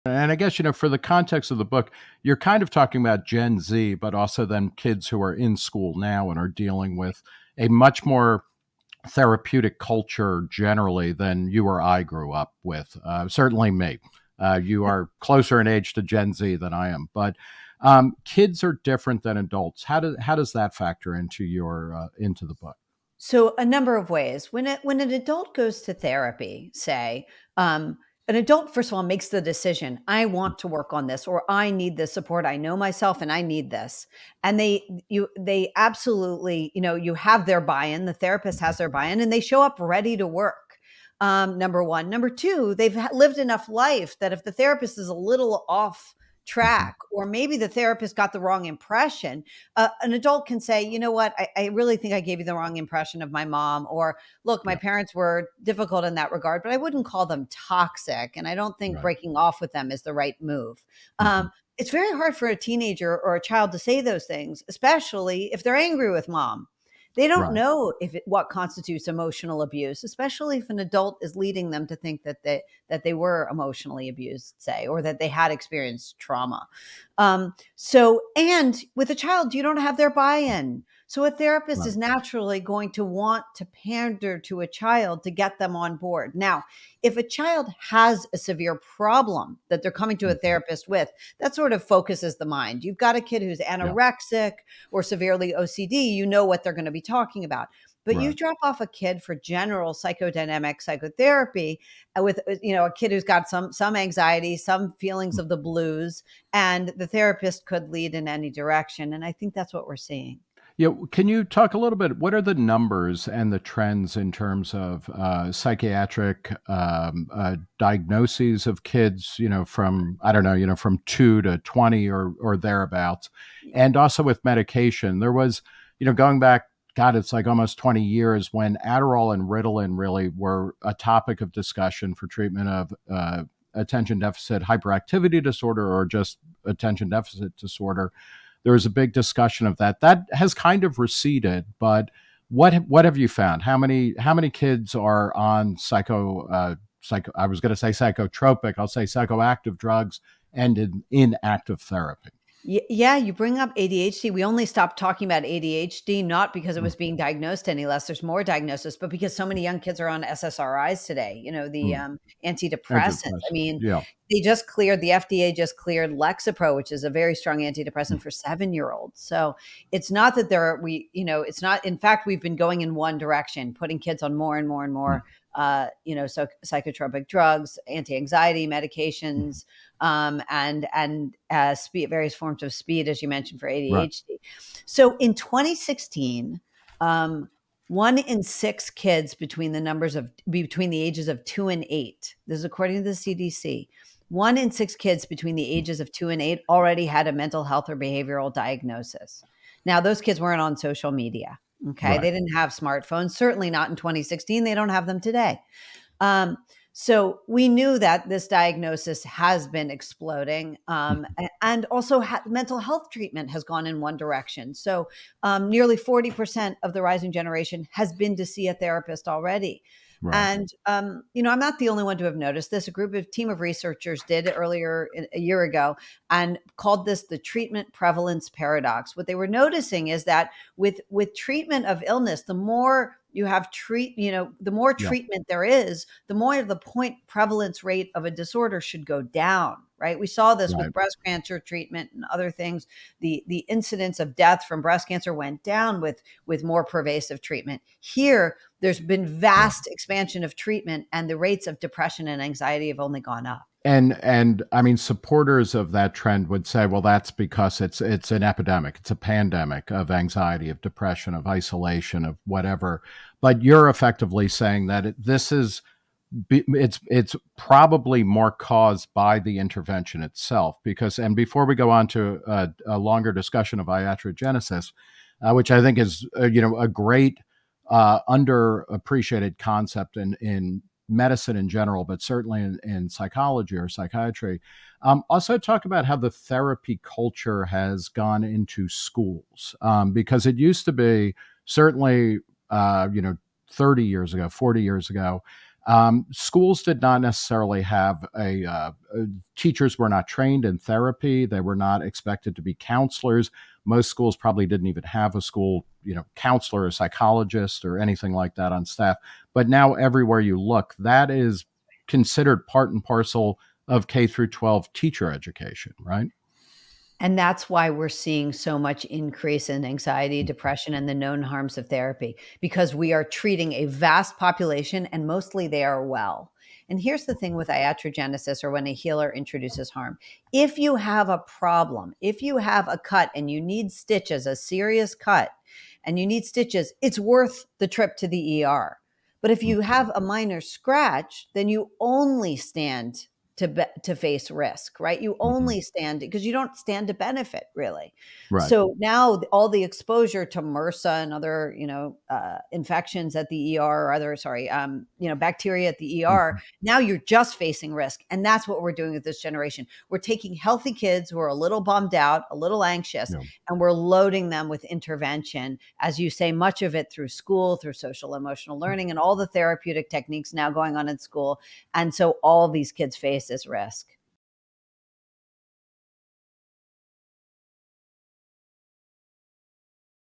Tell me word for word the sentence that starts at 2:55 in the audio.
Mm uh, you know, so, psychotropic drugs, anti-anxiety mm-hmm.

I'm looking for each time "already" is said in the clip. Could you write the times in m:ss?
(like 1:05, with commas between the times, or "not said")
3:16, 3:39.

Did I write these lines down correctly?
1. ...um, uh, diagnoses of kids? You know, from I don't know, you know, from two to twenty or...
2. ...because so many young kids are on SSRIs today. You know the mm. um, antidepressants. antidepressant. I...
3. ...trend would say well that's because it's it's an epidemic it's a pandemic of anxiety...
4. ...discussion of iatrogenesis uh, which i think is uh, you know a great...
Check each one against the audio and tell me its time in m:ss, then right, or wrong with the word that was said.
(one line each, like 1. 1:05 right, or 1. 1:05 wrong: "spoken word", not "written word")
1. 1:56 right
2. 2:39 right
3. 4:16 right
4. 4:33 right.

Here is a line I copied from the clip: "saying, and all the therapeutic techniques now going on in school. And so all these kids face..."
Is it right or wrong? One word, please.
wrong.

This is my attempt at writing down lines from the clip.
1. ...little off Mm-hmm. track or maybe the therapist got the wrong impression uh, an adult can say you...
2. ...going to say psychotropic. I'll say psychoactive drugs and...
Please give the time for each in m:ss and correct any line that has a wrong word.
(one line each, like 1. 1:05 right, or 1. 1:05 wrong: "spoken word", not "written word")
1. 0:45 right
2. 2:27 right.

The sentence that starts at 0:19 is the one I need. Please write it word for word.
How does how does that factor into your uh, into the book?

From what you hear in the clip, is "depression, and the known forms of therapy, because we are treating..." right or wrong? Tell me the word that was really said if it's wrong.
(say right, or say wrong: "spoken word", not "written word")
wrong: "harms", not "forms".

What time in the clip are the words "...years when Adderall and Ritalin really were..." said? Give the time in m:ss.
2:08.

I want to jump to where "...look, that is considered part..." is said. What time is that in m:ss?
5:10.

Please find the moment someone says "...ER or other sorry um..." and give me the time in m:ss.
5:53.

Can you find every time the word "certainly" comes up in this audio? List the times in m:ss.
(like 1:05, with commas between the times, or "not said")
0:13, 3:23, 4:42, 4:51.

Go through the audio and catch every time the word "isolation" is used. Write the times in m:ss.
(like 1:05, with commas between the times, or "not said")
4:21.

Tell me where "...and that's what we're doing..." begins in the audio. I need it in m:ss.
5:58.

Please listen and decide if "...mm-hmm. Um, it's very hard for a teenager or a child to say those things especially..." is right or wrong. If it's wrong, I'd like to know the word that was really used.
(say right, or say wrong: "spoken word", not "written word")
right.